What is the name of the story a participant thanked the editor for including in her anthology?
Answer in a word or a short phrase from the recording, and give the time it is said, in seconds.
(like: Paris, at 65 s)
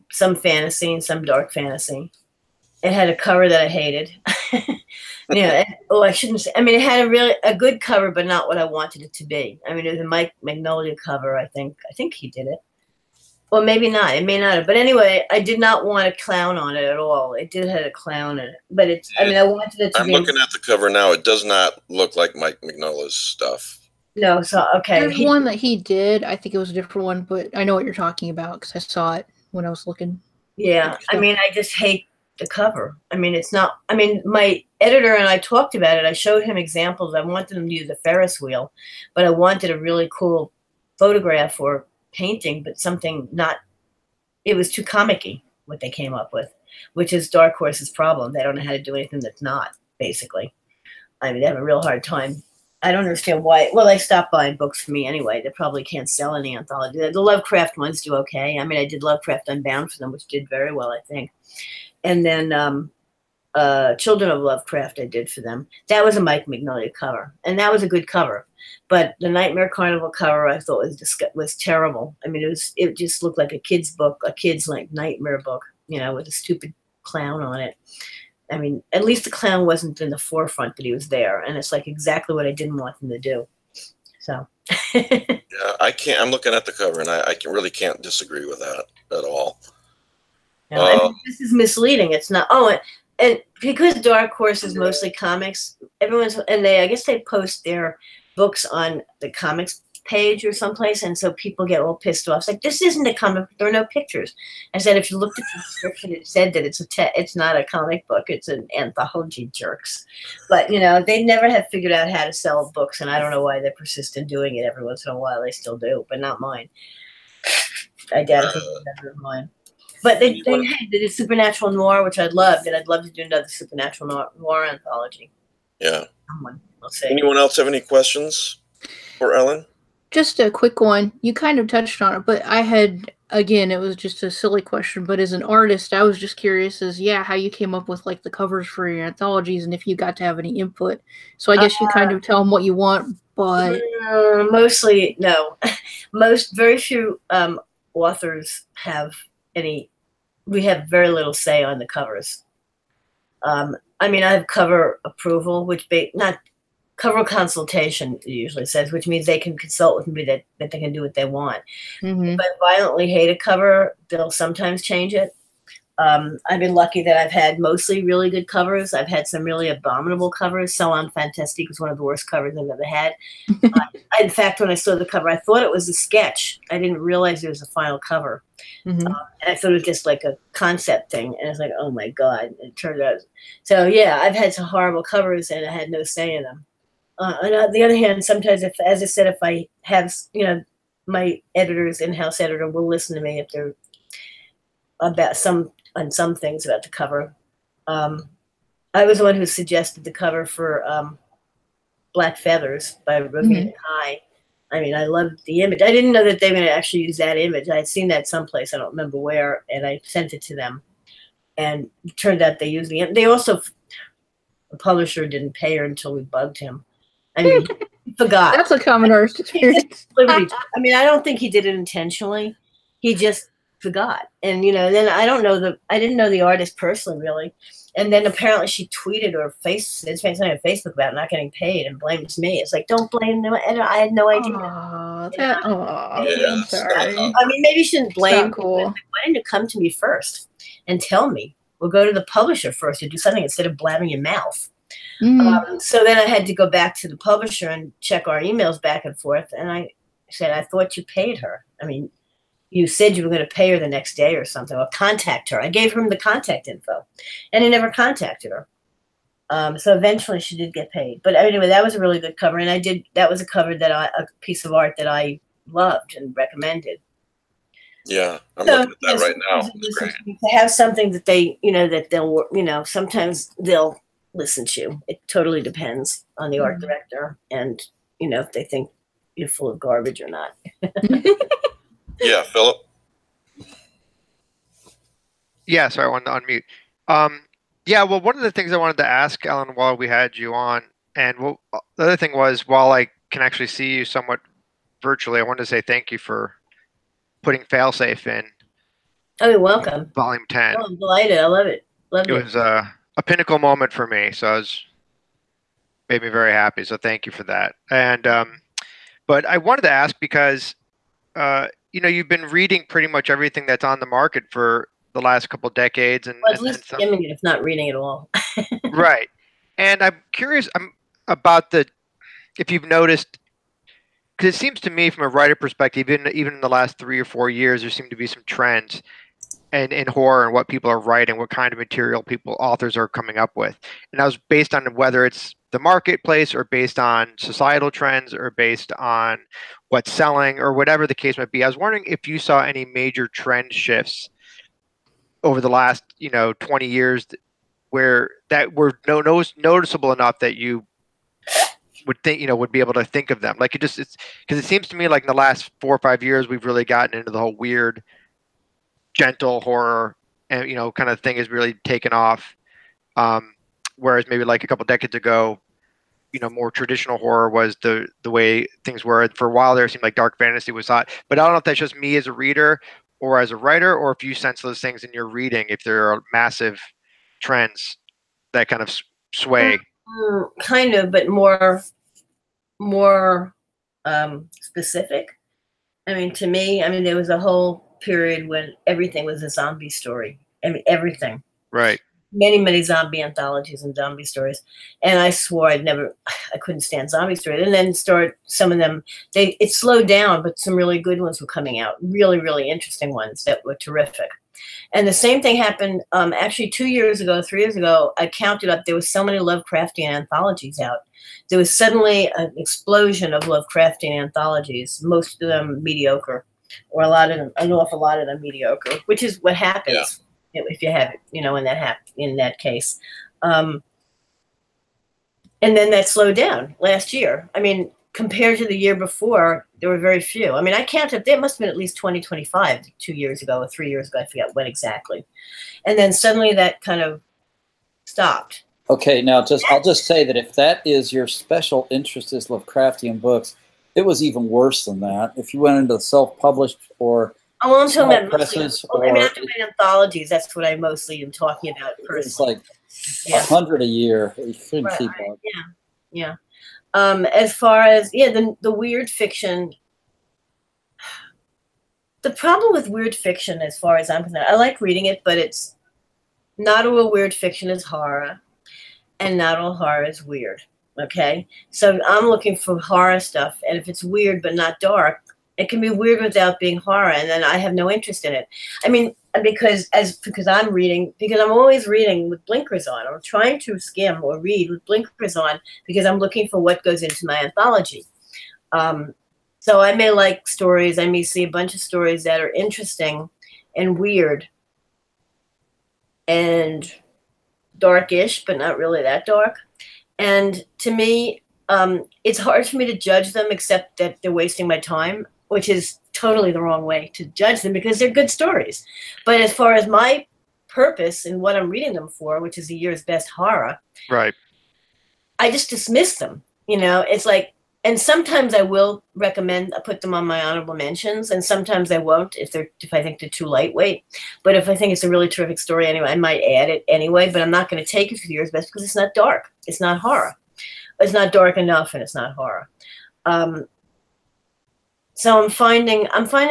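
Failsafe, at 297 s.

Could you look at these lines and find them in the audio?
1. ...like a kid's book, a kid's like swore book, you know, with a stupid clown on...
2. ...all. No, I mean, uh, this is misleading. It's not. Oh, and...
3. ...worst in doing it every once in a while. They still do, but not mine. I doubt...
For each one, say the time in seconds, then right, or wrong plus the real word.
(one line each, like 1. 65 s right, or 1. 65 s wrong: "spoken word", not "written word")
1. 73 s wrong: "nightmare", not "swore"
2. 89 s right
3. 113 s wrong: "persist", not "worst".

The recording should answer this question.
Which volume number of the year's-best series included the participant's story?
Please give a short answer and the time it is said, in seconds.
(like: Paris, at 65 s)
10, at 300 s.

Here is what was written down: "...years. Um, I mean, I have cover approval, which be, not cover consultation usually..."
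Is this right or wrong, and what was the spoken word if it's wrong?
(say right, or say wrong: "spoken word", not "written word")
wrong: "covers", not "years".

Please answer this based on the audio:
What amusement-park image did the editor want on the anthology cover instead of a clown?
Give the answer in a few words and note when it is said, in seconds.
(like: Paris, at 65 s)
A Ferris wheel, at 37 s.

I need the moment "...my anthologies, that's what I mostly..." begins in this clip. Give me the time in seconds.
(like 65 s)
449 s.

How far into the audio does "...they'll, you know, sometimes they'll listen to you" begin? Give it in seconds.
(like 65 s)
272 s.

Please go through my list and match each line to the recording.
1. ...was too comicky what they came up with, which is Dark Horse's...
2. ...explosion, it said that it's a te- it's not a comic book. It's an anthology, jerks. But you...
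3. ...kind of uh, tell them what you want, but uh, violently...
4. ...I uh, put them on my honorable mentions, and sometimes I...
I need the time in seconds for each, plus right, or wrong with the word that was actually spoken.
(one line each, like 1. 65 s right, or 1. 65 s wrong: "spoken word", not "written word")
1. 44 s right
2. 105 s wrong: "description", not "explosion"
3. 141 s wrong: "mostly", not "violently"
4. 519 s right.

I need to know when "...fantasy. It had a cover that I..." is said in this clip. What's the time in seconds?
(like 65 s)
1 s.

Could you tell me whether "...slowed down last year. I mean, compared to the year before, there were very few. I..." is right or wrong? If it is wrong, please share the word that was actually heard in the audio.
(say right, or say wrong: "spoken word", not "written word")
right.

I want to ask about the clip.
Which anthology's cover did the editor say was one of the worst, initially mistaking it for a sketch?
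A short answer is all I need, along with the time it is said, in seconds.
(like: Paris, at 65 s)
Salon Fantastique, at 170 s.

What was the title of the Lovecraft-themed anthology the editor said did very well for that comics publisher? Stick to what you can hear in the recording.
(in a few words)
Lovecraft Unbound.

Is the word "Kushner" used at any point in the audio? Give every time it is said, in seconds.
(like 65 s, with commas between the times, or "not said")
not said.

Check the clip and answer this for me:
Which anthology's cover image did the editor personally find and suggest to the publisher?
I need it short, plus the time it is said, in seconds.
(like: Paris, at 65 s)
Black Feathers, at 202 s.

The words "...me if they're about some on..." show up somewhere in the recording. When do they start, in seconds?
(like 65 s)
193 s.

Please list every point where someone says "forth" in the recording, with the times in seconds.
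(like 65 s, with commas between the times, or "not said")
249 s.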